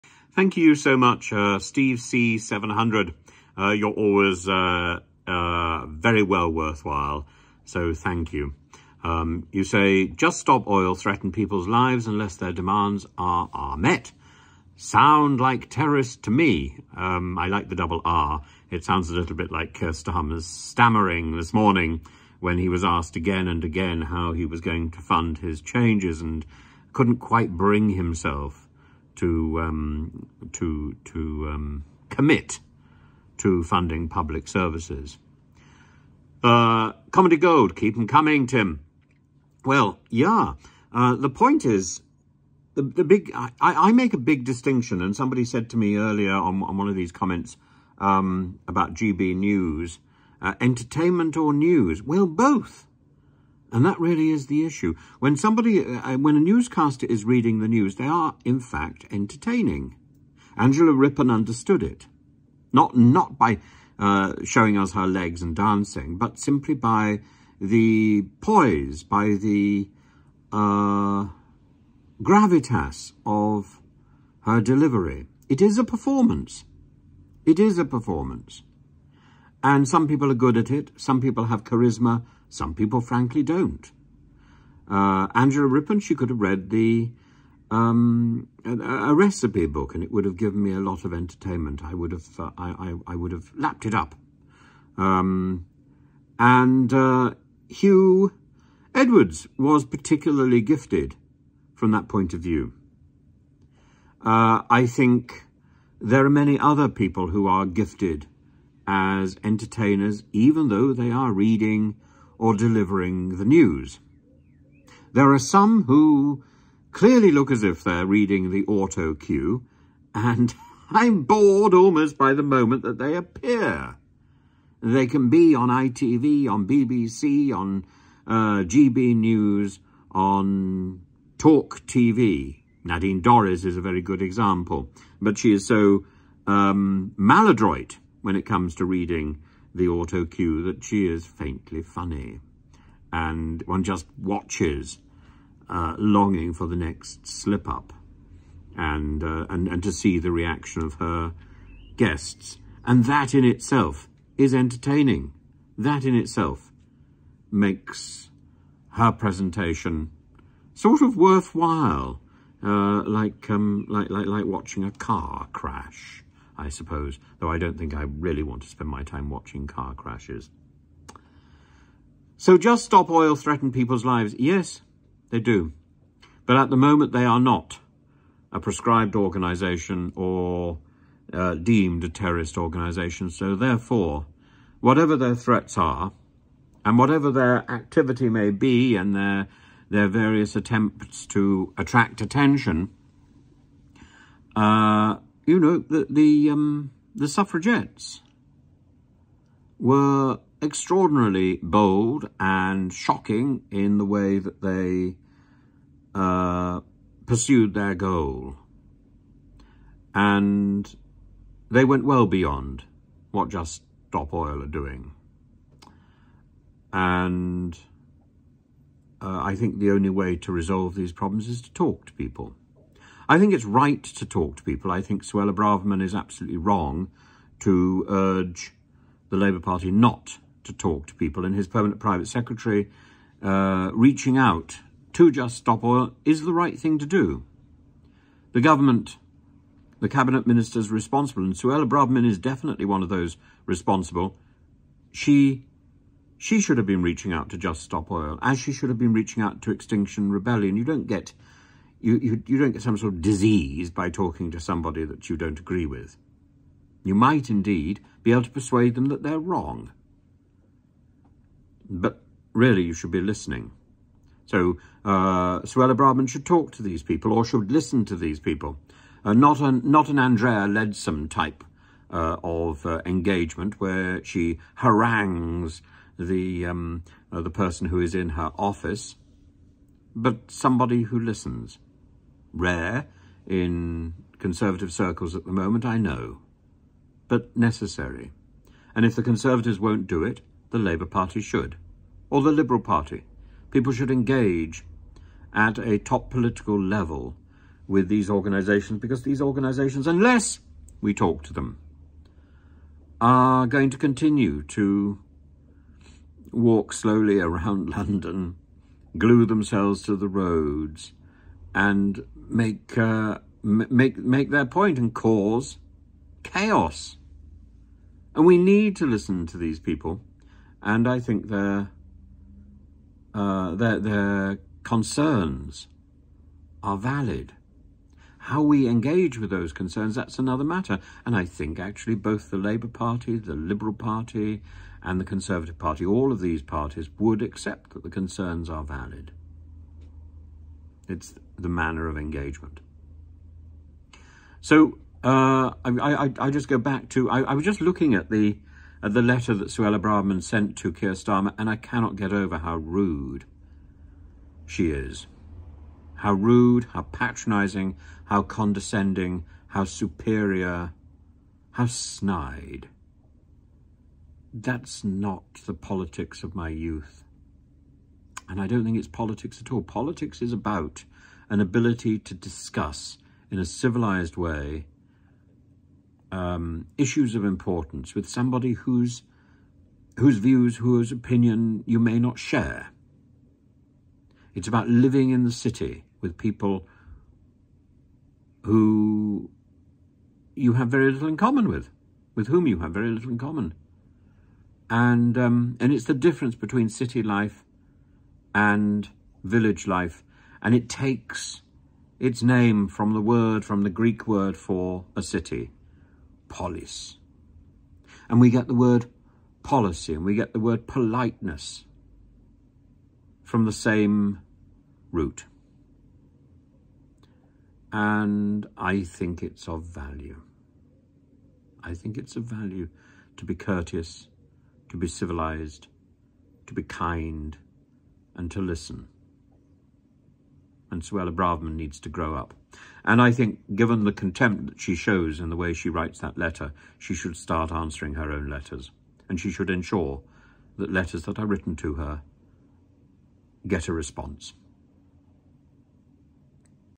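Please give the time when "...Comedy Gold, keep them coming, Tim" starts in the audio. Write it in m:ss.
0:37.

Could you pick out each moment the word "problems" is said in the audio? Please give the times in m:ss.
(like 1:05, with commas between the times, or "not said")
3:41.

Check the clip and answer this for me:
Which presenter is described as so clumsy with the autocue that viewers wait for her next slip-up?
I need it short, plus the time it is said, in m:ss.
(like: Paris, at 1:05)
Nadine Dorries, at 2:12.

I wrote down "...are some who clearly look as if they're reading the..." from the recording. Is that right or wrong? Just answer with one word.
right.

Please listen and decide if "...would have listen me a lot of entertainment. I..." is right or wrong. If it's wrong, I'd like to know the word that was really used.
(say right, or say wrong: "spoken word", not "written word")
wrong: "given", not "listen".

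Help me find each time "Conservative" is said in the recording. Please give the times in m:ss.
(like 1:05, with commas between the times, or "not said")
4:44, 4:49, 5:35.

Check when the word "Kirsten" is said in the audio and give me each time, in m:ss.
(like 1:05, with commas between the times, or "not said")
0:19.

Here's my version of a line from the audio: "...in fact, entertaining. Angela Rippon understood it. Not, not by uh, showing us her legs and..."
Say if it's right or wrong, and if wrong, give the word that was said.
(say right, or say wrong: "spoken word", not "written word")
right.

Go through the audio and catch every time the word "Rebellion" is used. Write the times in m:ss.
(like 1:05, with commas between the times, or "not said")
4:10.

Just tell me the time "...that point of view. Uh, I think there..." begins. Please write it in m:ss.
1:41.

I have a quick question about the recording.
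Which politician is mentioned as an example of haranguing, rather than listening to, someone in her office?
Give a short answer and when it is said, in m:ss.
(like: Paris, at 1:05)
Andrea Leadsom, at 4:30.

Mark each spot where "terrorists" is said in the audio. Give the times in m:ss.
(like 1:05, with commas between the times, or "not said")
0:15, 3:02.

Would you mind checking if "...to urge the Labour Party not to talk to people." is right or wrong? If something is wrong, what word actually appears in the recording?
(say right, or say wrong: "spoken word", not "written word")
right.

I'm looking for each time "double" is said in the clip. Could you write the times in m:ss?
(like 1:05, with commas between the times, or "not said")
0:17.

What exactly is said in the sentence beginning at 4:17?
You might indeed be able to persuade them that they're wrong.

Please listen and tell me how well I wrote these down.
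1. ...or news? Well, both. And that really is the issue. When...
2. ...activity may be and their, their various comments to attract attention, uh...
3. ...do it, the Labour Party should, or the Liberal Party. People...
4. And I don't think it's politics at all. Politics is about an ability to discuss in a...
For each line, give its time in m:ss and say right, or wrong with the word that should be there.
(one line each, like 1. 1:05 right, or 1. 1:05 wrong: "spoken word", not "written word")
1. 0:51 right
2. 3:07 wrong: "attempts", not "comments"
3. 4:50 right
4. 6:08 right.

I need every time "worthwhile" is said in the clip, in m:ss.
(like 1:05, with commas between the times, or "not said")
0:06, 2:41.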